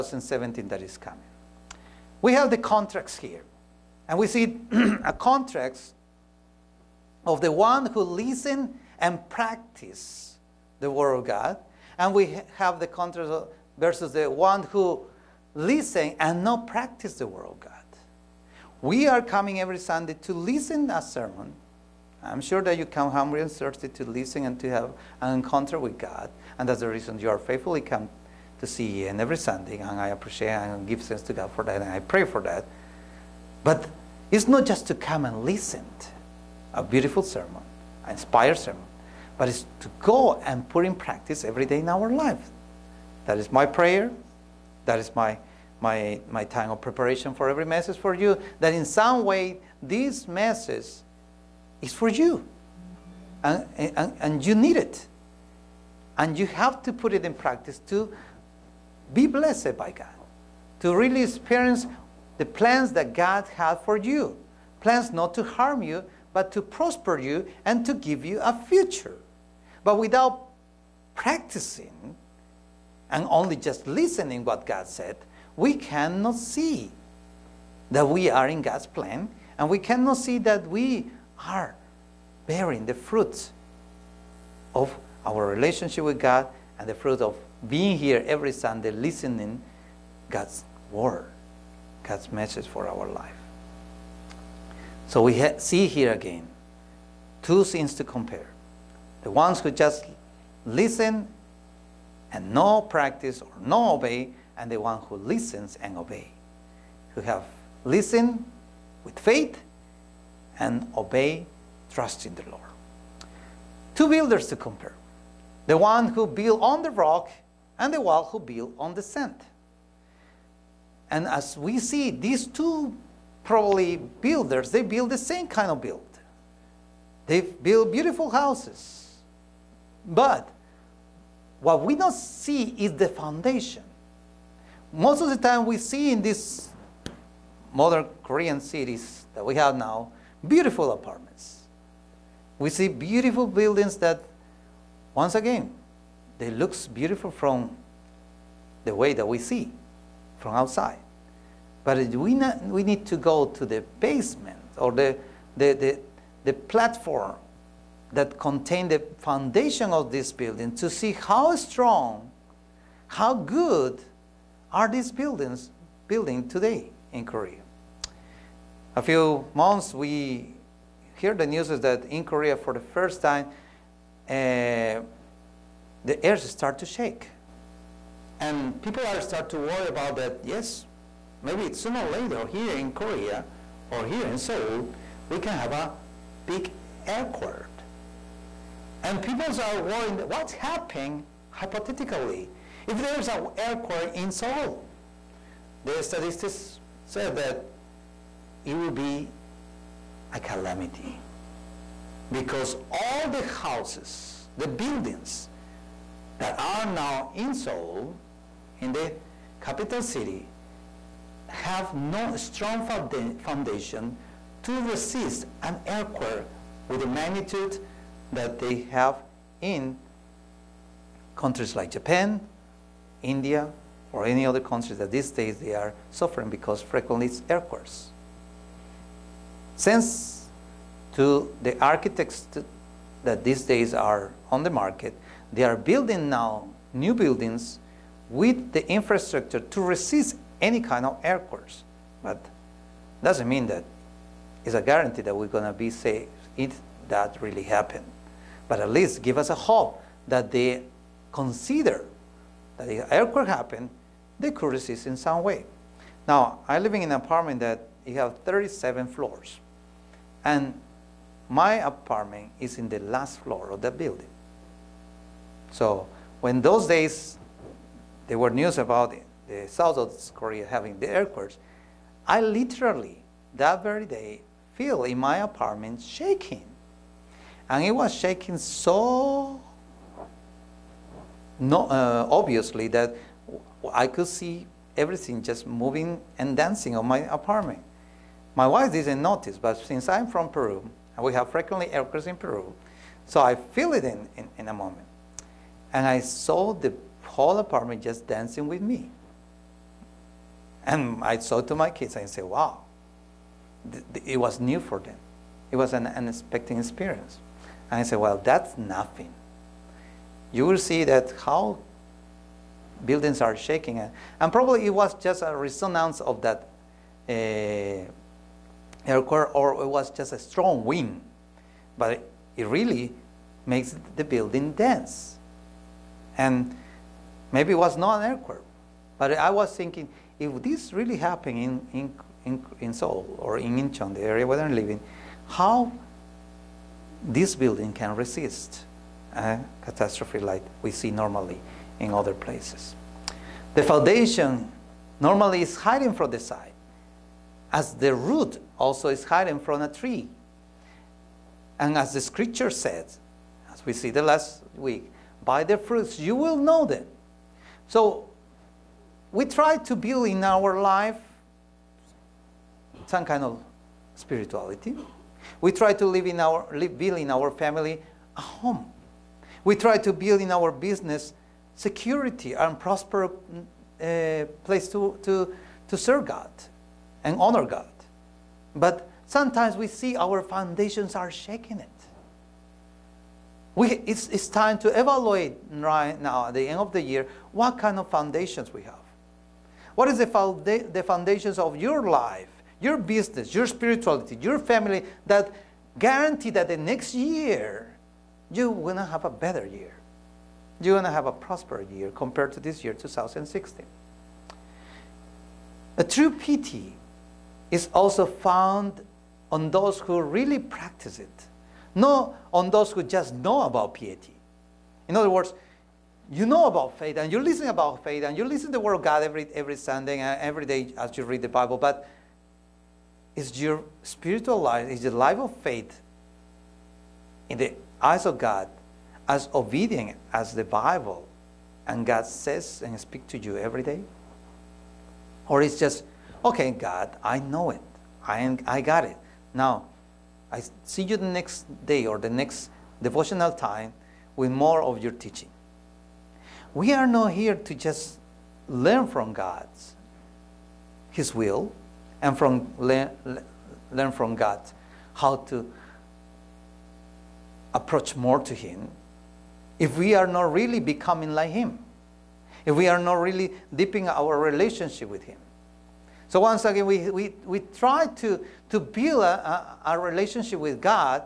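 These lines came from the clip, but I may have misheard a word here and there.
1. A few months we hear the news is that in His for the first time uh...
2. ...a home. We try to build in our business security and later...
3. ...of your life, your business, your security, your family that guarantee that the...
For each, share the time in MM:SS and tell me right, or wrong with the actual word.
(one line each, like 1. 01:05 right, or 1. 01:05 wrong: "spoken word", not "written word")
1. 02:48 wrong: "Korea", not "His"
2. 06:08 wrong: "prosper", not "later"
3. 06:31 wrong: "spirituality", not "security".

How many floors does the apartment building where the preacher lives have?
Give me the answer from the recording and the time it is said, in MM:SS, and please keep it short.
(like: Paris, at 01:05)
37, at 04:18.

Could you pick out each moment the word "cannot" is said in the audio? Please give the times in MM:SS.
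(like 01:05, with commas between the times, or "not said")
01:15, 01:19.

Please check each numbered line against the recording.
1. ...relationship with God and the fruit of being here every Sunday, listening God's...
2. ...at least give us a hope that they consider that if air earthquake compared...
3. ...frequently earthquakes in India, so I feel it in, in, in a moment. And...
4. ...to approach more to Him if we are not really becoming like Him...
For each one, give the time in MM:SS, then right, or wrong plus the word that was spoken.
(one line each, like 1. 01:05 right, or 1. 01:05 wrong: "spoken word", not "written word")
1. 01:25 right
2. 04:08 wrong: "happened", not "compared"
3. 04:51 wrong: "Peru", not "India"
4. 07:35 right.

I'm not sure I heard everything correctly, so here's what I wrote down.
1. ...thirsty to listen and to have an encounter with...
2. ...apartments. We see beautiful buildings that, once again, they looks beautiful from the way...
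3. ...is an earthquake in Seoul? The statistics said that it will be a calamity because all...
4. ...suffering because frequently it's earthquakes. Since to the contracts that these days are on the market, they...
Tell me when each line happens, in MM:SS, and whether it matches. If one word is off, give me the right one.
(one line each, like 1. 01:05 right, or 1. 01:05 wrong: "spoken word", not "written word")
1. 00:23 right
2. 02:20 right
3. 03:13 right
4. 03:46 wrong: "architects", not "contracts".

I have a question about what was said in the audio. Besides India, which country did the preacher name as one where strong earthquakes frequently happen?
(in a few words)
Japan.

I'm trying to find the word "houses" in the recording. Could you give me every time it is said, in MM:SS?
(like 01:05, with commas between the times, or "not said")
02:08, 03:23.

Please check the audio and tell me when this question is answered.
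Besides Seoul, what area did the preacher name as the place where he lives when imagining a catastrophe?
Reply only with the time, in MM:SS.
05:33.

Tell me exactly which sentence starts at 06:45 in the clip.
A true piety is also found on those who really practice it not on those who just know about piety.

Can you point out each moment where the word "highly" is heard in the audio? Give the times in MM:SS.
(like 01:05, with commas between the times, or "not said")
not said.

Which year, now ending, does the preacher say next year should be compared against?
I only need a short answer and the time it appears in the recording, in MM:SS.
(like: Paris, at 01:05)
2016, at 06:42.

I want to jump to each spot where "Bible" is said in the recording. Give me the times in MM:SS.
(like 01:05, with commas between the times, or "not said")
07:01, 07:10.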